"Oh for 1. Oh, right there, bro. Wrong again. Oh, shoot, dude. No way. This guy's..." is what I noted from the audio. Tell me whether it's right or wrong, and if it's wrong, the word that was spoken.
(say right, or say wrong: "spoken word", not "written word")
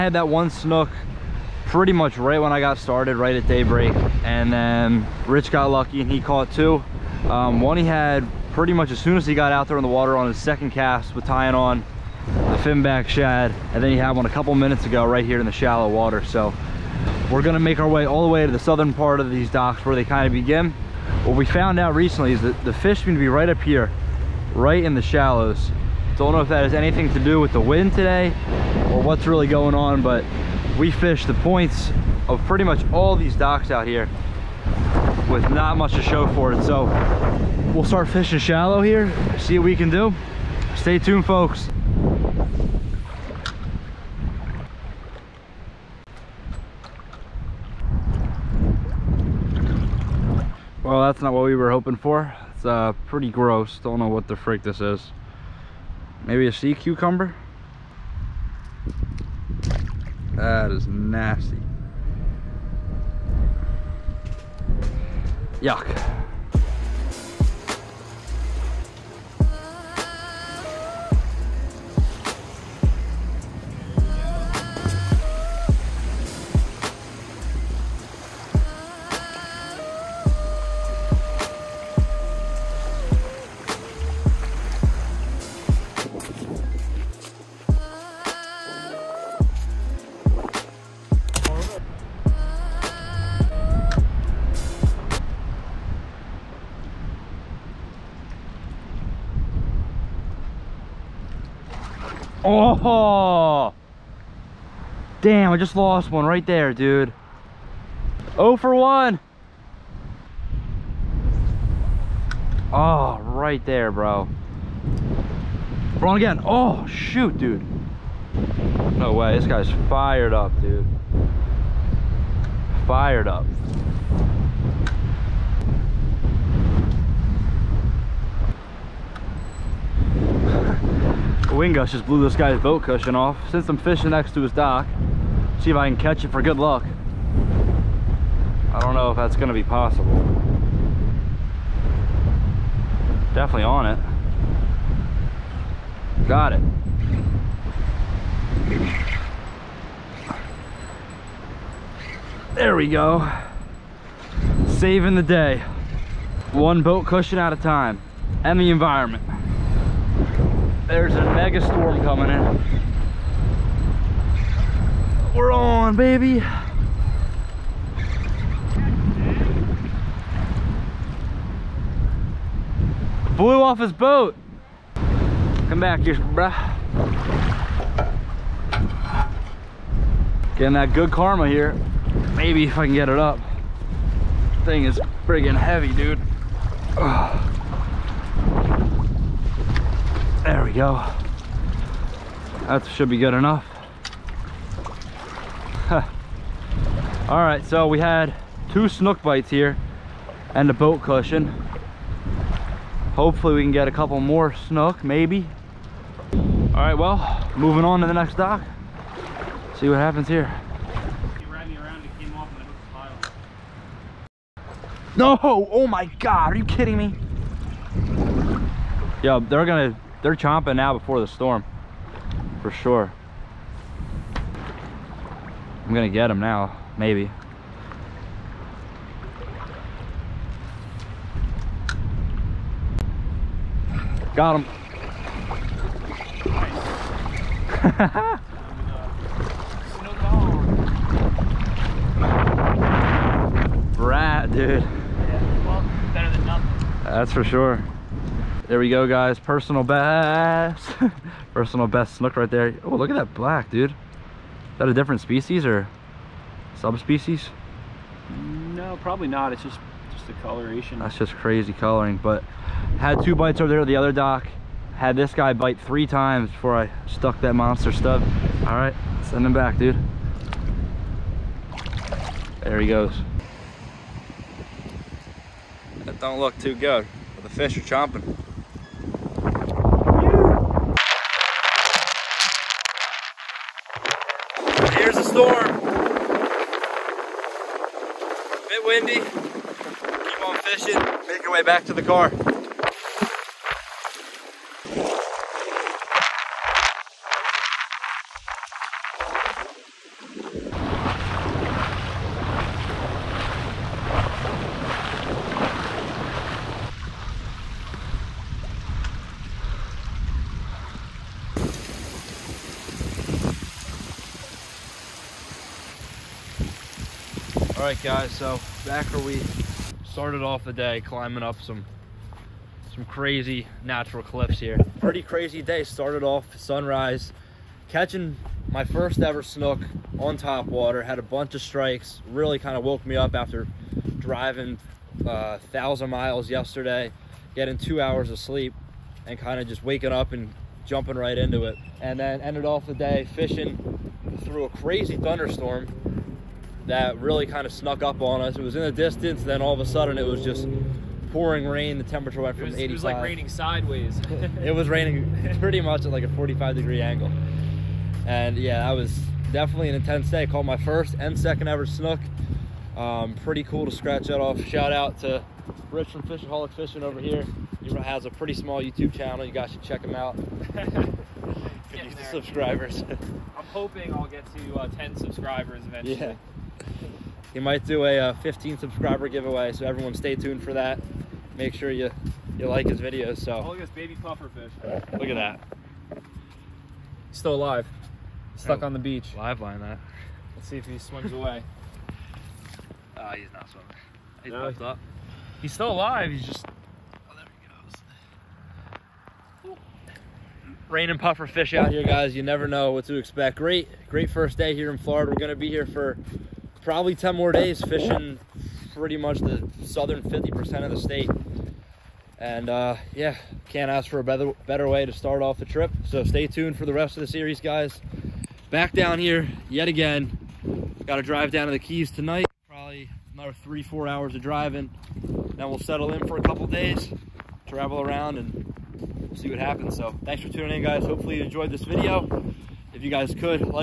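right.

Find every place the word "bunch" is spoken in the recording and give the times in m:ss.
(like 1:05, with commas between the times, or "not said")
5:31.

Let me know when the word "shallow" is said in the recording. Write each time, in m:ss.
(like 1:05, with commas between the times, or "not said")
0:15, 0:25, 0:38.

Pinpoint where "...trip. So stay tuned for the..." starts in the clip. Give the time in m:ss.
6:55.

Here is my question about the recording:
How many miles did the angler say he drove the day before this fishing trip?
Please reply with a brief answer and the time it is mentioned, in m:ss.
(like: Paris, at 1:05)
1000, at 5:35.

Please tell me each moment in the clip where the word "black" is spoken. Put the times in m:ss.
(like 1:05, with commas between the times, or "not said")
4:13.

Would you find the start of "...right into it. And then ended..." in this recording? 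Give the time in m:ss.
5:41.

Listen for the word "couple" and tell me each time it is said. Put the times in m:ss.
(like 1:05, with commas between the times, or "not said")
0:14, 3:23, 7:06.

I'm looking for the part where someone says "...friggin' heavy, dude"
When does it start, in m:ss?
3:05.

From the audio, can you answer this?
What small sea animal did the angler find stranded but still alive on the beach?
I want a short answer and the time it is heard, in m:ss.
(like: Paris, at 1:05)
Baby pufferfish, at 6:23.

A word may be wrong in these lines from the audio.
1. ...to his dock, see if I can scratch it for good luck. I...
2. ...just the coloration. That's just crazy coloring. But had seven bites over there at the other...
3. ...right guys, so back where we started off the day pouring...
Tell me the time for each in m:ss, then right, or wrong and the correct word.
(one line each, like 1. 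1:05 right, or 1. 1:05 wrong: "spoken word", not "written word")
1. 2:14 wrong: "catch", not "scratch"
2. 4:20 wrong: "two", not "seven"
3. 5:17 wrong: "climbing", not "pouring".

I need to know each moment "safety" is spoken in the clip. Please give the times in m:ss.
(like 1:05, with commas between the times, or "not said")
not said.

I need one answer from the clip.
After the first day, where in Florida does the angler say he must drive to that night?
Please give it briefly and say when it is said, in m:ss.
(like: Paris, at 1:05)
The Keys, at 7:01.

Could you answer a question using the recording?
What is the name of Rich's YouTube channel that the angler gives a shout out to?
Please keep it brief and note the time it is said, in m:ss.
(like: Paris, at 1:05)
Fishaholic Fishing, at 6:06.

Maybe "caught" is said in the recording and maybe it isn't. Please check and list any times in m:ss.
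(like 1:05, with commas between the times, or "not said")
0:06, 6:00.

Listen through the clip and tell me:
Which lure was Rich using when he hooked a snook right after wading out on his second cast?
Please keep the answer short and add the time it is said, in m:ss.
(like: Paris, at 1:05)
Finback shad, at 0:12.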